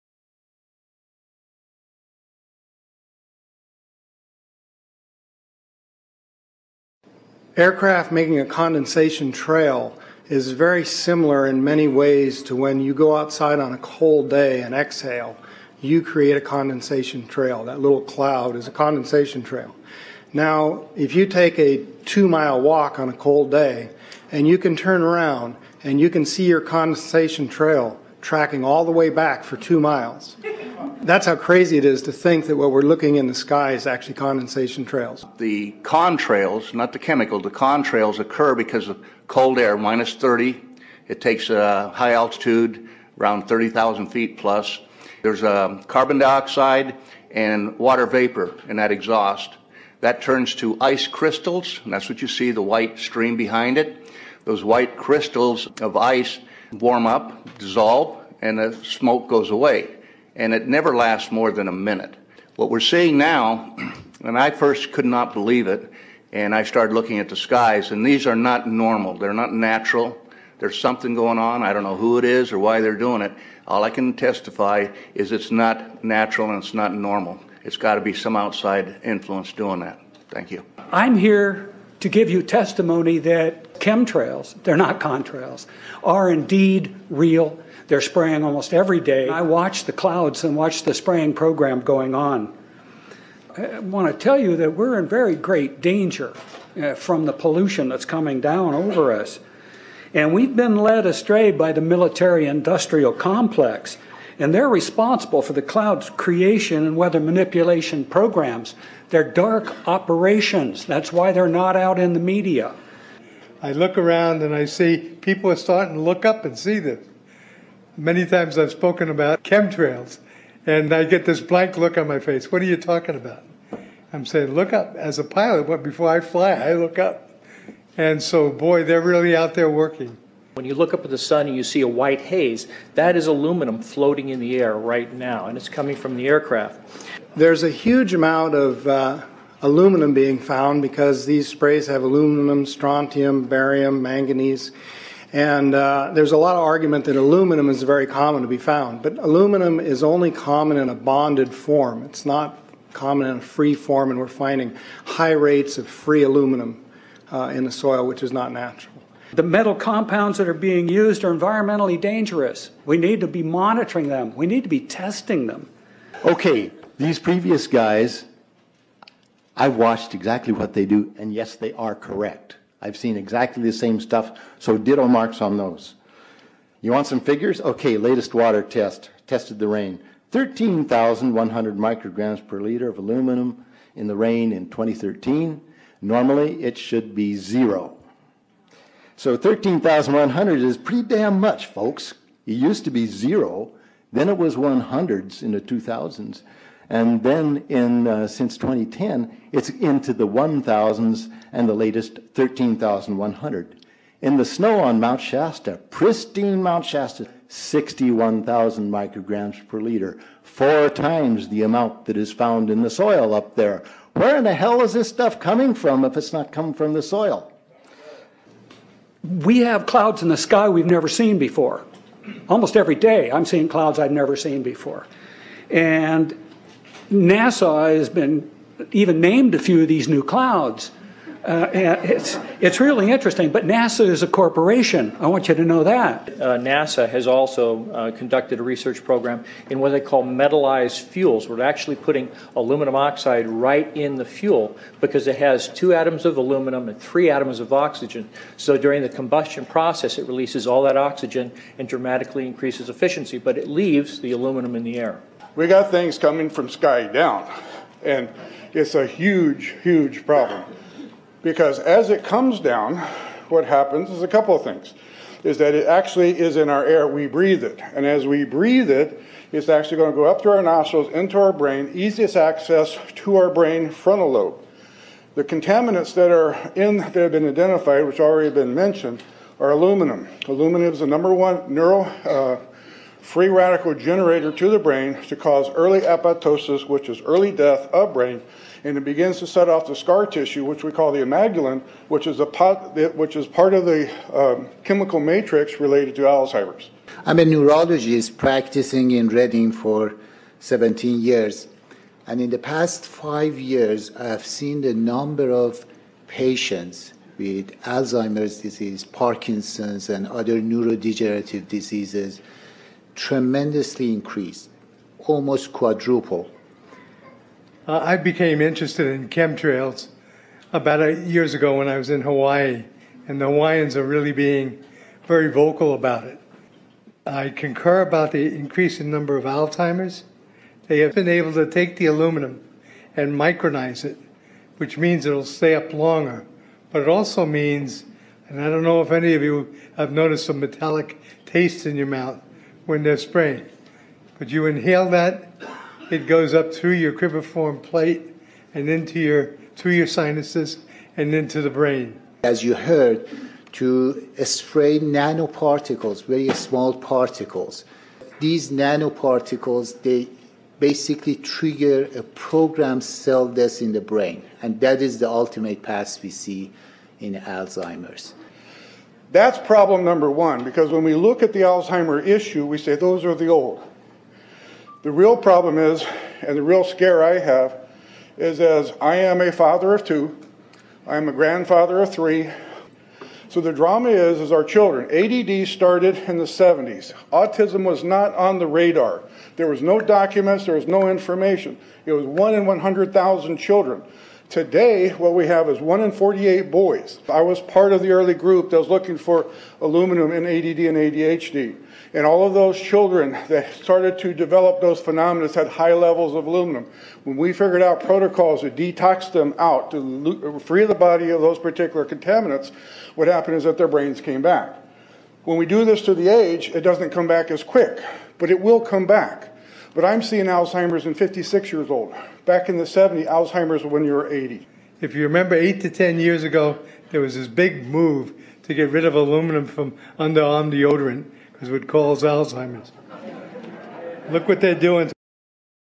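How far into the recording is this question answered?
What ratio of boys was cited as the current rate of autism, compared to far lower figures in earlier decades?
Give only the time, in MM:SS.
06:35.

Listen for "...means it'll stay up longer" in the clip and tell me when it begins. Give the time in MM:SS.
05:34.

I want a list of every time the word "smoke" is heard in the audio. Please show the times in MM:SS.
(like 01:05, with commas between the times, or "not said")
00:58.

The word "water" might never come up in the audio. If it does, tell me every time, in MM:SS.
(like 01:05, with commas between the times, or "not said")
00:47, 02:58.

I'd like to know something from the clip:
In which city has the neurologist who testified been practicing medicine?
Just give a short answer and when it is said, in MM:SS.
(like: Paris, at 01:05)
Redding, at 04:59.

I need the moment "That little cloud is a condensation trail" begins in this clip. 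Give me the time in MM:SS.
00:17.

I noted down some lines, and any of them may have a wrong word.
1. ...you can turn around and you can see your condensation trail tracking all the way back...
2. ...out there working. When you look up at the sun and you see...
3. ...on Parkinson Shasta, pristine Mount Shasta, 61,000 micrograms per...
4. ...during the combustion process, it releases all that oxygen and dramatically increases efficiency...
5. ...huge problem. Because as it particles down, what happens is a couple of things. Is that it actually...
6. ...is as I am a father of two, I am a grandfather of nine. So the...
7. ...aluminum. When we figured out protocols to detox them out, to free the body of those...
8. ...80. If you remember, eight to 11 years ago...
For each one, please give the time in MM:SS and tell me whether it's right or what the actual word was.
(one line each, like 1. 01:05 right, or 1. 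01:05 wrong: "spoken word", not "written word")
1. 00:24 right
2. 02:09 right
3. 03:24 wrong: "Mount", not "Parkinson"
4. 04:08 right
5. 04:19 wrong: "comes", not "particles"
6. 06:18 wrong: "three", not "nine"
7. 06:46 right
8. 07:04 wrong: "10", not "11".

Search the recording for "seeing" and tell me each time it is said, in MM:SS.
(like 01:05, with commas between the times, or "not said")
01:02, 03:43, 07:00.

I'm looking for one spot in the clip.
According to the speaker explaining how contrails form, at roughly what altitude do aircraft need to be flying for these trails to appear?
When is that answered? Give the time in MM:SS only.
00:43.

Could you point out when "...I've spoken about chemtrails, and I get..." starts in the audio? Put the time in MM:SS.
01:58.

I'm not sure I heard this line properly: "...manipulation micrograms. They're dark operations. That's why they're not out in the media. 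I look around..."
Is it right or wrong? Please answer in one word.
wrong.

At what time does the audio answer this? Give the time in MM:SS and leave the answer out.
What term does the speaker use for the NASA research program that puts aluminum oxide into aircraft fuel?
04:00.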